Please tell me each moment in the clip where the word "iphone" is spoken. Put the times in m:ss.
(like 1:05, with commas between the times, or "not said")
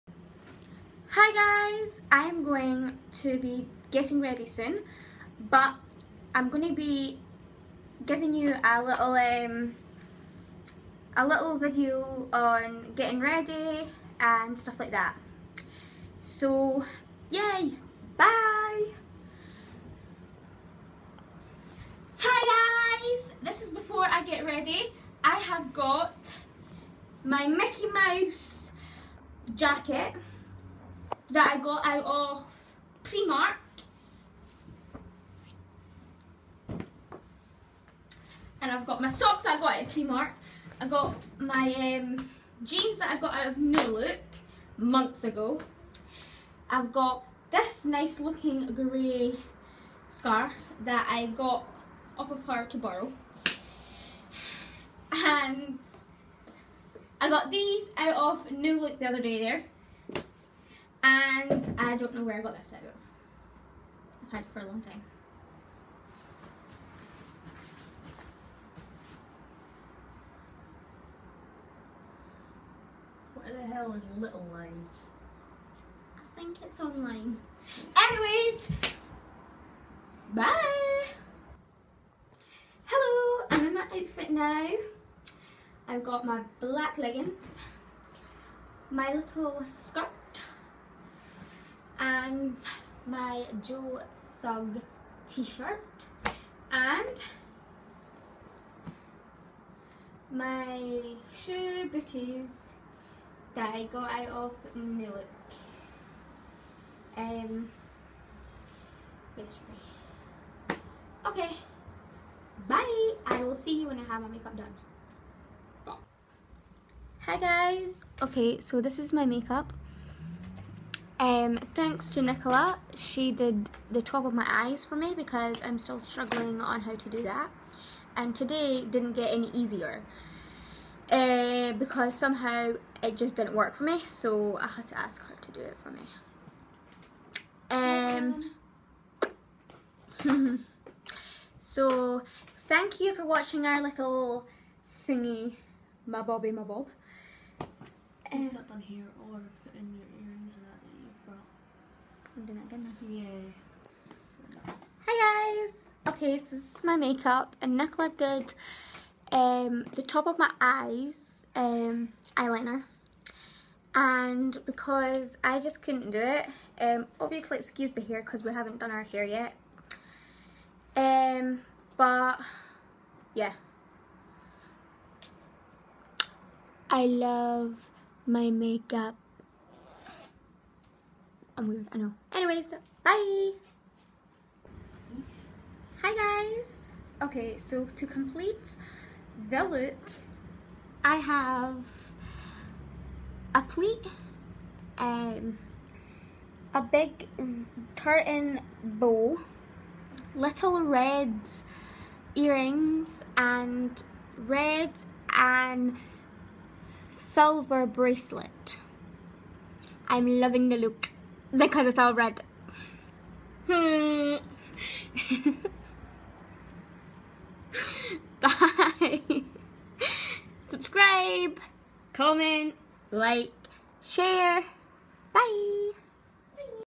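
not said.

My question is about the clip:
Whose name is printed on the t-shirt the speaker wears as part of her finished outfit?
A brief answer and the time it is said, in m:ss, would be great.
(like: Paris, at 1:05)
Joe Sugg, at 1:33.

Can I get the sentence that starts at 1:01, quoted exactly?
And I don't know where I got this out I've had it for a long time.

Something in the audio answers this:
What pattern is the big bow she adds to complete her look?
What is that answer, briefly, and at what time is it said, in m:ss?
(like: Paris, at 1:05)
Tartan, at 3:17.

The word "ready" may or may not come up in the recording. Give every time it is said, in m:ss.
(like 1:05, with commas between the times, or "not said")
0:04, 0:13, 0:24.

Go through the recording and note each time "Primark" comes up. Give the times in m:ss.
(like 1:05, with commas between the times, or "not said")
0:33, 0:39.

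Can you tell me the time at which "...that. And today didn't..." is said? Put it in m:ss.
2:07.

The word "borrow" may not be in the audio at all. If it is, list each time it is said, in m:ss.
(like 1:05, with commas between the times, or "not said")
0:52.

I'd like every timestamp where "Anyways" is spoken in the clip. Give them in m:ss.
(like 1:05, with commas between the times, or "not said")
1:17, 3:02.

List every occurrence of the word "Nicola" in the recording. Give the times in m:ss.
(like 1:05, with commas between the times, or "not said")
2:02, 2:37.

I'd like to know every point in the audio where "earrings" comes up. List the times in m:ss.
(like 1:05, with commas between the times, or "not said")
3:22.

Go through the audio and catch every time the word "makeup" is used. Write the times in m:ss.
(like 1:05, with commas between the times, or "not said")
1:54, 1:59, 2:36, 2:58.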